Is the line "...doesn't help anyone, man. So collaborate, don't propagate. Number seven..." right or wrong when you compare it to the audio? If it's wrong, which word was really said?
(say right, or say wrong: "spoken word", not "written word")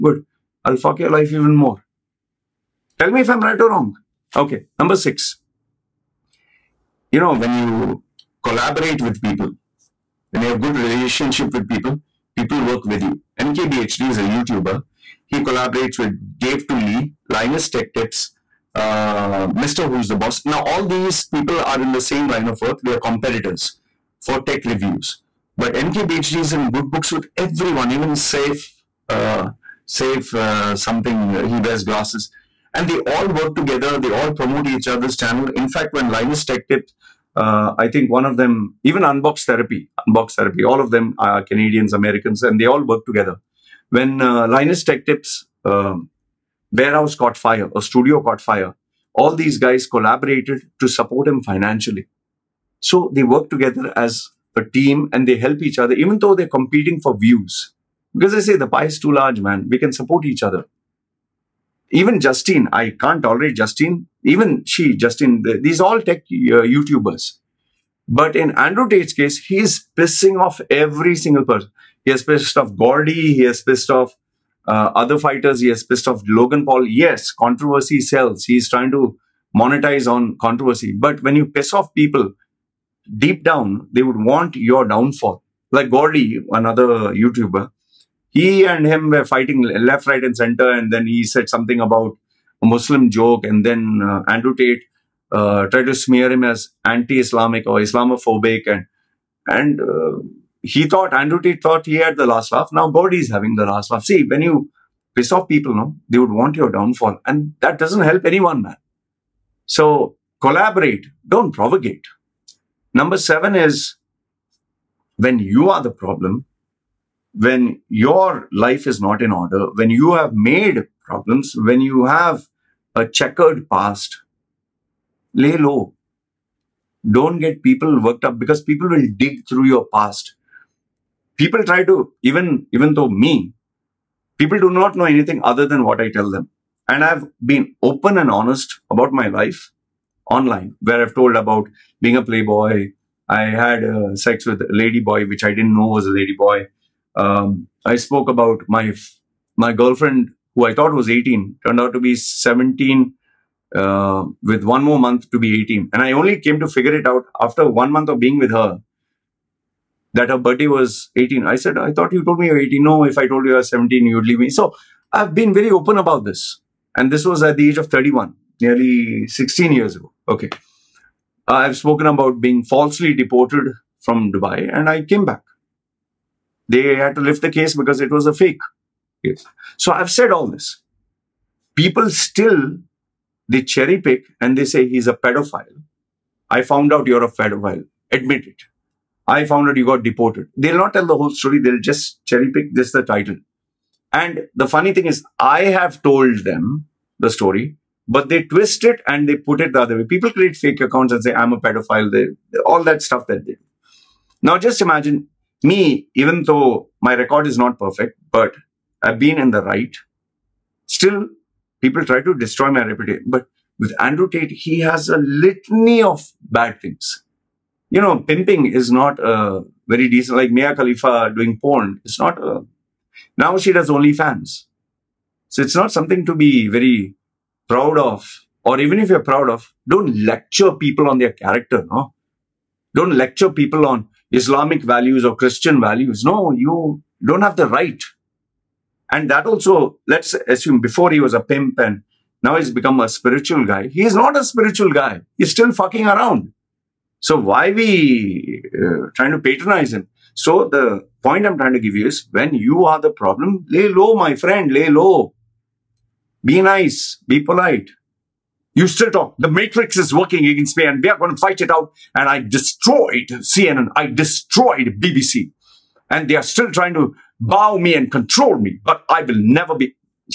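right.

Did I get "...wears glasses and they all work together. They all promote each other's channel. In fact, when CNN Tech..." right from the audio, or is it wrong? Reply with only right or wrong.
wrong.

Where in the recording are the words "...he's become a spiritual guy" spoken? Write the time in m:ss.
4:02.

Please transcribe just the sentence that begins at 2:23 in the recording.
I had uh, sex with a lady boy, which I didn't know was a lady boy.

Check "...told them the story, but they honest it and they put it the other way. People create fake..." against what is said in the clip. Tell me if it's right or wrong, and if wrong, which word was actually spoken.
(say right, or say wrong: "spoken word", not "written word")
wrong: "twist", not "honest".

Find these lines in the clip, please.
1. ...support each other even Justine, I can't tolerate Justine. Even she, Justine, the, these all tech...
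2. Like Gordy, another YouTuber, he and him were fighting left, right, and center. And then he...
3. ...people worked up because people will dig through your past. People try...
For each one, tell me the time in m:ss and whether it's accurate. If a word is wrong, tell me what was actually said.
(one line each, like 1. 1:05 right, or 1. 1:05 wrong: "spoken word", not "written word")
1. 0:59 right
2. 1:25 right
3. 2:07 right.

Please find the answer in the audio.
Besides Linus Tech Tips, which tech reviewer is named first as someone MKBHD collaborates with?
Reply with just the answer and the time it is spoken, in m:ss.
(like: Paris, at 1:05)
Dave2D, at 0:16.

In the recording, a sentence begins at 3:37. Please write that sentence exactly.
You know, pimping is not a very decent, like Mia Khalifa doing porn.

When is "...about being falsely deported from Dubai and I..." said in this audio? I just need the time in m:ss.
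2:52.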